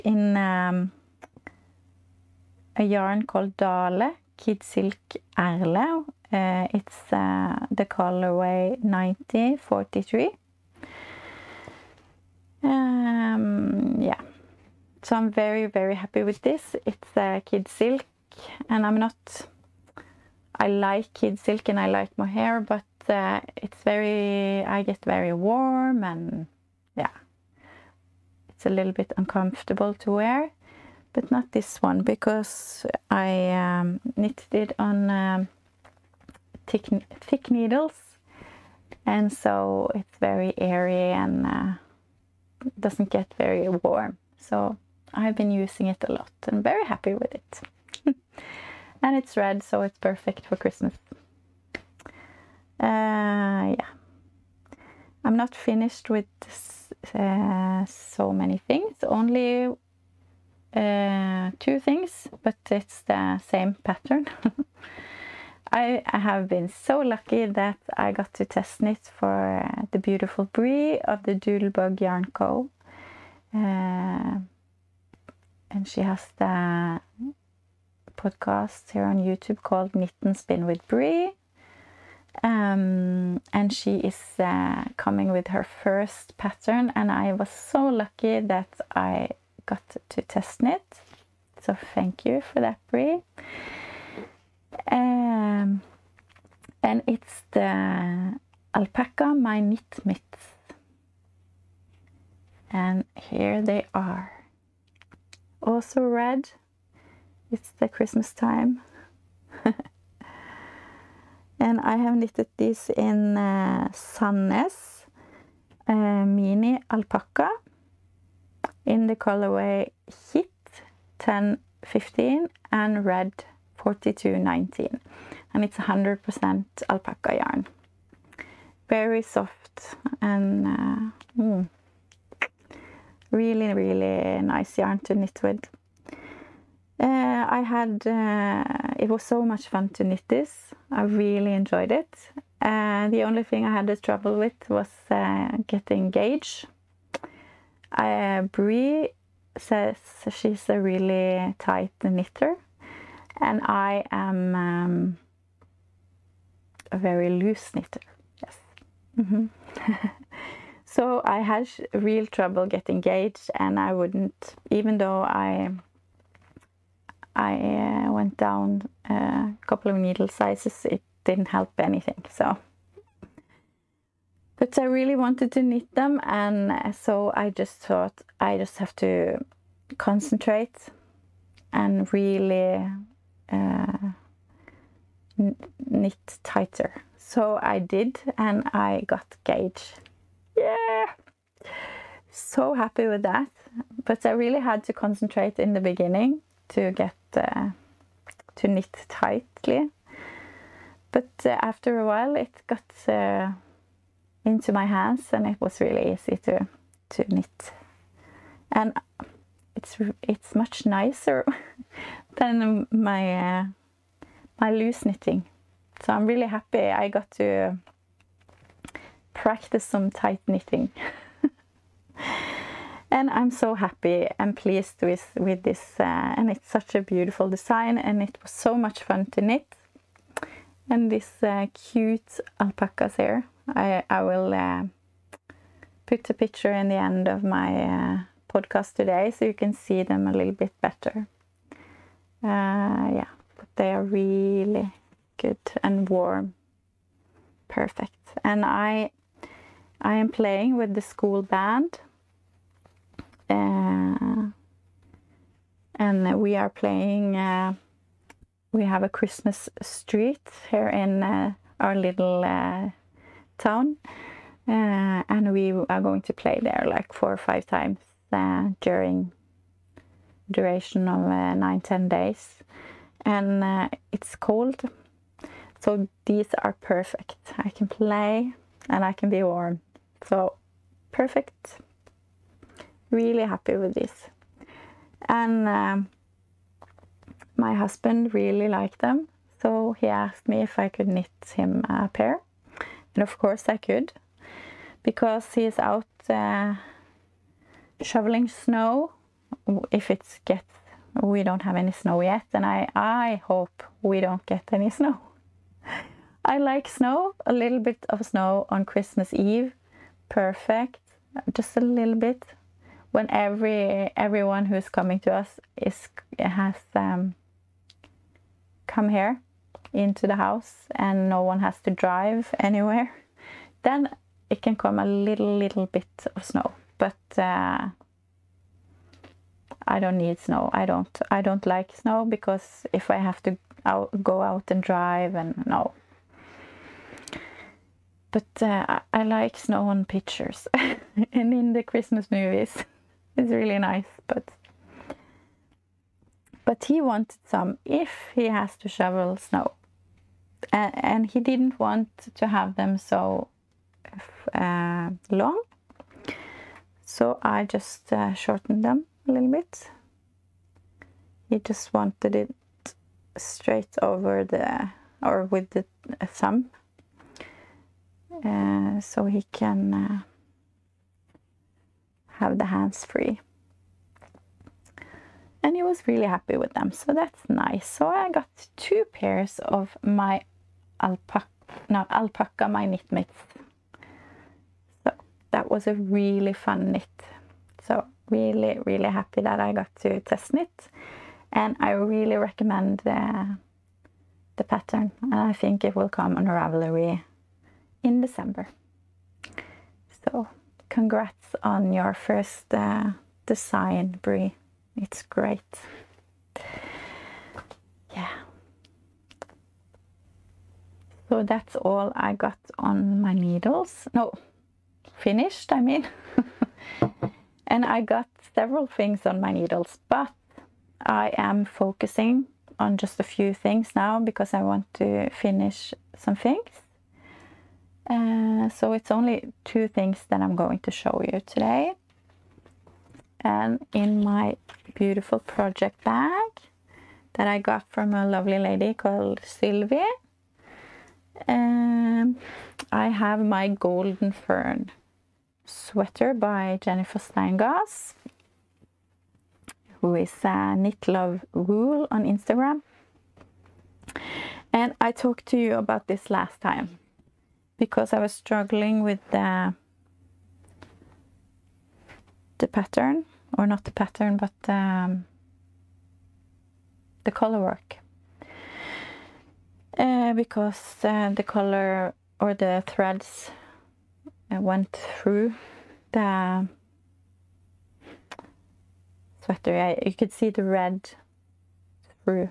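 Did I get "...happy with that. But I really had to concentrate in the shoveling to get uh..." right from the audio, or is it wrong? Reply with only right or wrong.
wrong.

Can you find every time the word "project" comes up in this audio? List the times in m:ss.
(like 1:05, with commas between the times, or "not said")
7:15.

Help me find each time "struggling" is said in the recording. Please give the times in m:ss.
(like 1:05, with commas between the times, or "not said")
7:38.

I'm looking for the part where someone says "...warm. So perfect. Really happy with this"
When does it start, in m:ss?
4:39.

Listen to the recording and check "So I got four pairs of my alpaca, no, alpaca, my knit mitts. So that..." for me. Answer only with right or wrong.
wrong.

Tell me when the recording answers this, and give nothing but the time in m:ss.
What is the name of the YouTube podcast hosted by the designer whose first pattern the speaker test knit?
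1:19.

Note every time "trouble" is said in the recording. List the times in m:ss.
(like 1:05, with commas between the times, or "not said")
2:23, 2:42.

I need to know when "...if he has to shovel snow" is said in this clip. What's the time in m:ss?
5:47.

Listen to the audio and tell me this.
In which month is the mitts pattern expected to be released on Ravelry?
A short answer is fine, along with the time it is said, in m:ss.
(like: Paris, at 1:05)
December, at 6:38.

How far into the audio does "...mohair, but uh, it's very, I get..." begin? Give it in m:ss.
0:22.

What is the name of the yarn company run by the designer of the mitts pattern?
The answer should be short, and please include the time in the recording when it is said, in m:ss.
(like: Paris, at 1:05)
Doodlebug Yarn Co., at 1:11.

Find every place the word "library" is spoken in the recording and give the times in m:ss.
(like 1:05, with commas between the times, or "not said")
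not said.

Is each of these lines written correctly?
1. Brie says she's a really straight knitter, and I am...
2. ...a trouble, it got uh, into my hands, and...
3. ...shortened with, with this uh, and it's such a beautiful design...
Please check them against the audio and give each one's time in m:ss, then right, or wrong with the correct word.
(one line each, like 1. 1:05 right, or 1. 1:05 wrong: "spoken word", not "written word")
1. 2:28 wrong: "tight", not "straight"
2. 3:21 wrong: "while", not "trouble"
3. 3:44 wrong: "pleased", not "shortened".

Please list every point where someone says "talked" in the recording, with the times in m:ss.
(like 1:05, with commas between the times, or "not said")
7:35.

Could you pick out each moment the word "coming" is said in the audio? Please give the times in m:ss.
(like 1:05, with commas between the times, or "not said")
1:24, 5:14.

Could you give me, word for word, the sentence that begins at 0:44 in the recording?
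So I've been using it a lot and very happy with it.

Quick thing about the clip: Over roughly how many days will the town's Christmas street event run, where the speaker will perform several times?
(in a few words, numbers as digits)
9 or 10 days.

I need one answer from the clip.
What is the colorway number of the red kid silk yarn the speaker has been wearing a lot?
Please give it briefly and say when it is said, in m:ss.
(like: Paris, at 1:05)
9043, at 0:08.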